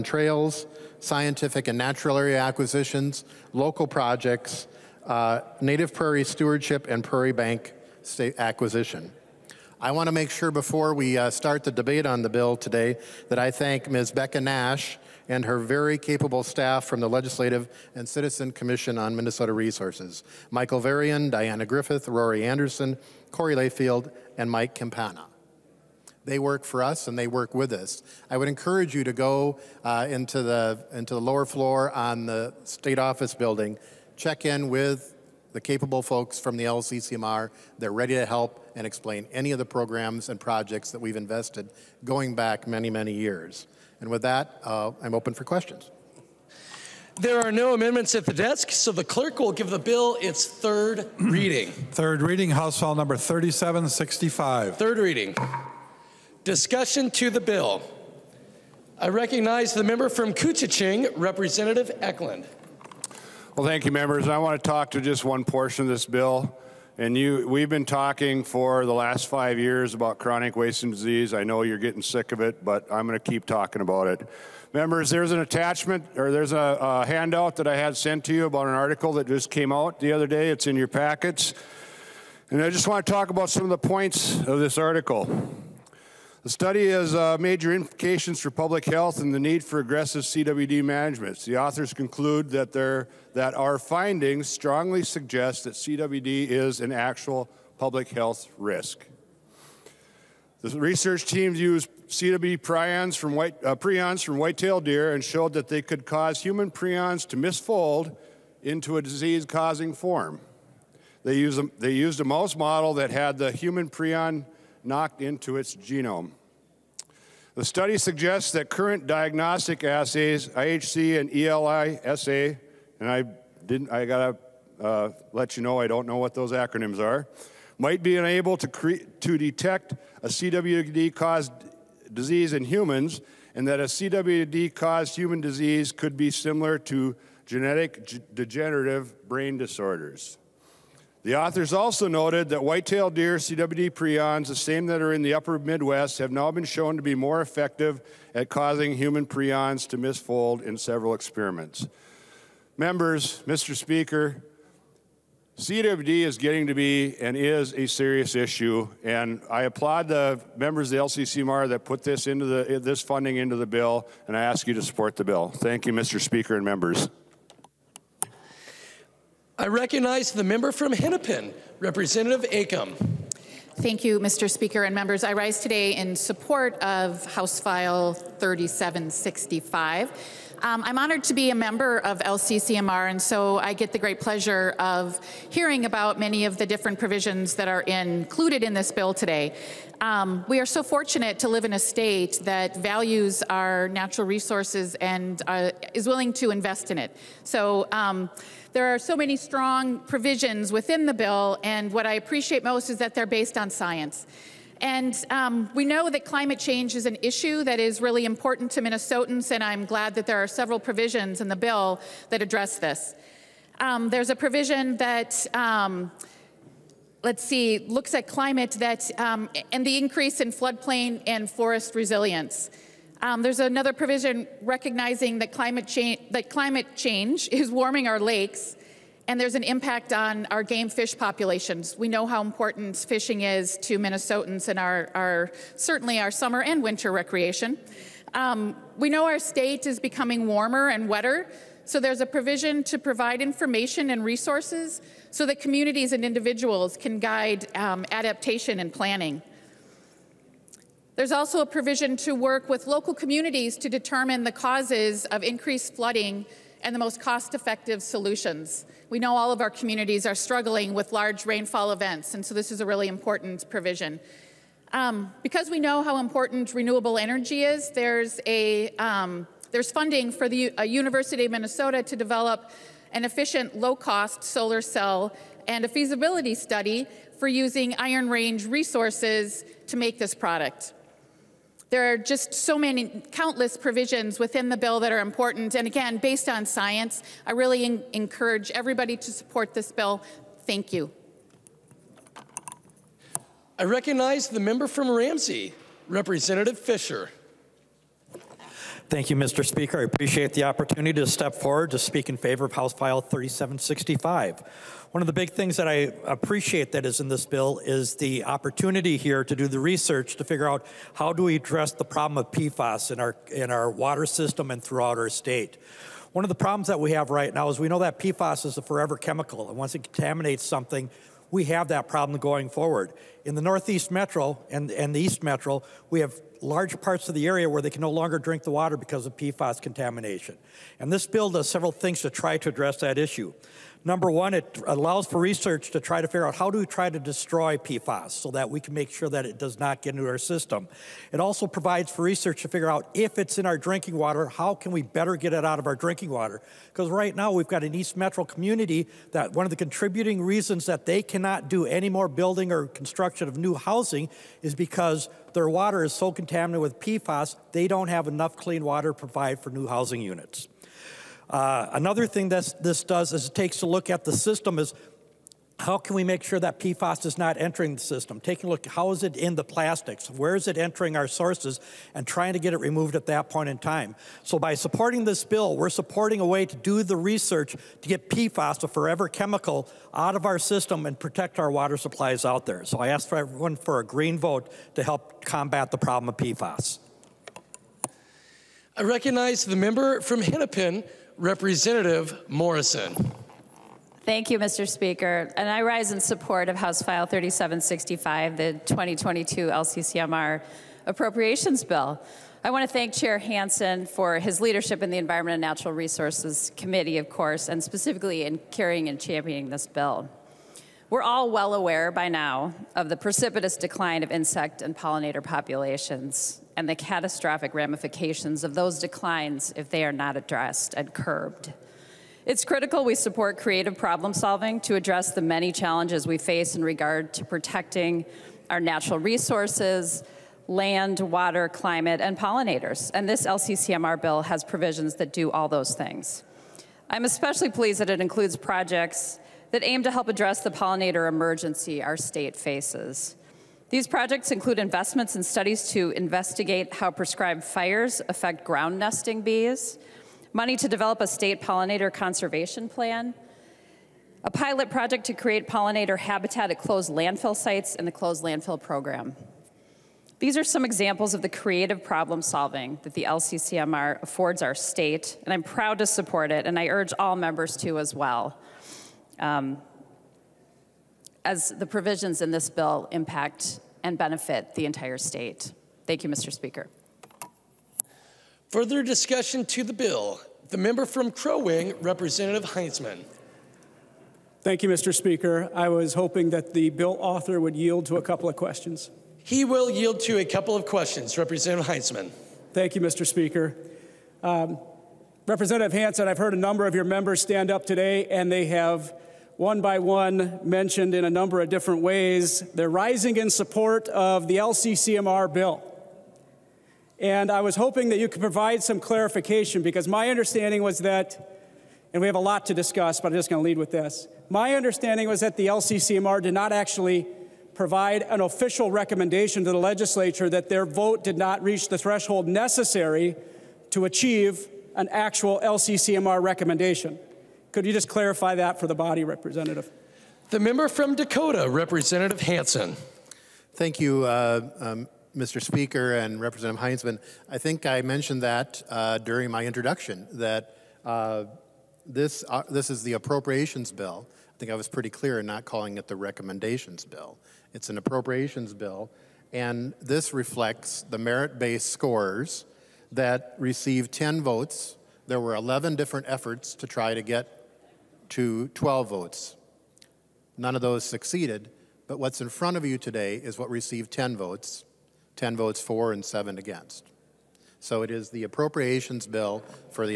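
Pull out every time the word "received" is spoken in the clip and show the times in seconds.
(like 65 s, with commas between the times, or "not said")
553 s, 563 s.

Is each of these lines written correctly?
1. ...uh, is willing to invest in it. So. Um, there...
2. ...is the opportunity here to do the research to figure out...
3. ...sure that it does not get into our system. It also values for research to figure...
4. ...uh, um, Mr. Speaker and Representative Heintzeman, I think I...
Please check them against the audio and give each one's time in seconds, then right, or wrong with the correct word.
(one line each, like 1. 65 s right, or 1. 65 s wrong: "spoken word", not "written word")
1. 195 s right
2. 307 s right
3. 339 s wrong: "provides", not "values"
4. 534 s right.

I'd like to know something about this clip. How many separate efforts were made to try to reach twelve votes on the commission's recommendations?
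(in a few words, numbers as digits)
11.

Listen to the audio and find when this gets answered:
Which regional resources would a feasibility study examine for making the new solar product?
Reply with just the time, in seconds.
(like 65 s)
277 s.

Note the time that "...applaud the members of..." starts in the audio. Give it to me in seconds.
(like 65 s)
159 s.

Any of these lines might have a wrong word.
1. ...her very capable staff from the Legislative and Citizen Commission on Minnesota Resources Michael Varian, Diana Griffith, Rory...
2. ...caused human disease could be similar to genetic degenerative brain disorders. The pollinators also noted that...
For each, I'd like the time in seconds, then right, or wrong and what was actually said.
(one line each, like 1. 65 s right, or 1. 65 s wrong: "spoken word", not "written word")
1. 15 s right
2. 134 s wrong: "authors", not "pollinators".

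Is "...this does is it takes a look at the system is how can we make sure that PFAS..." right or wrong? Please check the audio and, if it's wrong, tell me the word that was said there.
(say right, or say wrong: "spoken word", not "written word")
right.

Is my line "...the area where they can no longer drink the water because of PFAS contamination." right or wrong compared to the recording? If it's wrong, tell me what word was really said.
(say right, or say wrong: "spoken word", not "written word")
right.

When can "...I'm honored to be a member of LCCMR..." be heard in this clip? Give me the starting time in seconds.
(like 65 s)
180 s.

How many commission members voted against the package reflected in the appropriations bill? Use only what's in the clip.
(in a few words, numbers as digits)
7.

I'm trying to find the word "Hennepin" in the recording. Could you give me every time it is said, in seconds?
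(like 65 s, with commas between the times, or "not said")
170 s, 390 s.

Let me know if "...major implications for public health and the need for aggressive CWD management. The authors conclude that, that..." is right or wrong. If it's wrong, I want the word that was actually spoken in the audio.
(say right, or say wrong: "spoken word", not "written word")
right.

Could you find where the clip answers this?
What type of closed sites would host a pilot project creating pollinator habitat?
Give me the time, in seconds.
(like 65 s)
457 s.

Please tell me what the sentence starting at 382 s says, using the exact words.
So I ask for everyone for a green vote to help combat the problem of PFAS.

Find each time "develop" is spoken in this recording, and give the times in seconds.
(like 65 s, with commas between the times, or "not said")
272 s, 450 s.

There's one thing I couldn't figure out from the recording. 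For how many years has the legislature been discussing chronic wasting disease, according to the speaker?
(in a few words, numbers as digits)
5.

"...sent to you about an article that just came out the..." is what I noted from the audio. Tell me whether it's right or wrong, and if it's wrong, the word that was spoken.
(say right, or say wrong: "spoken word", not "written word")
right.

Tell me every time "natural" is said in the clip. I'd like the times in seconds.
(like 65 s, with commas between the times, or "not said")
1 s, 193 s, 405 s, 428 s.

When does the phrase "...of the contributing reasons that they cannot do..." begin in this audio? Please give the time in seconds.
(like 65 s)
349 s.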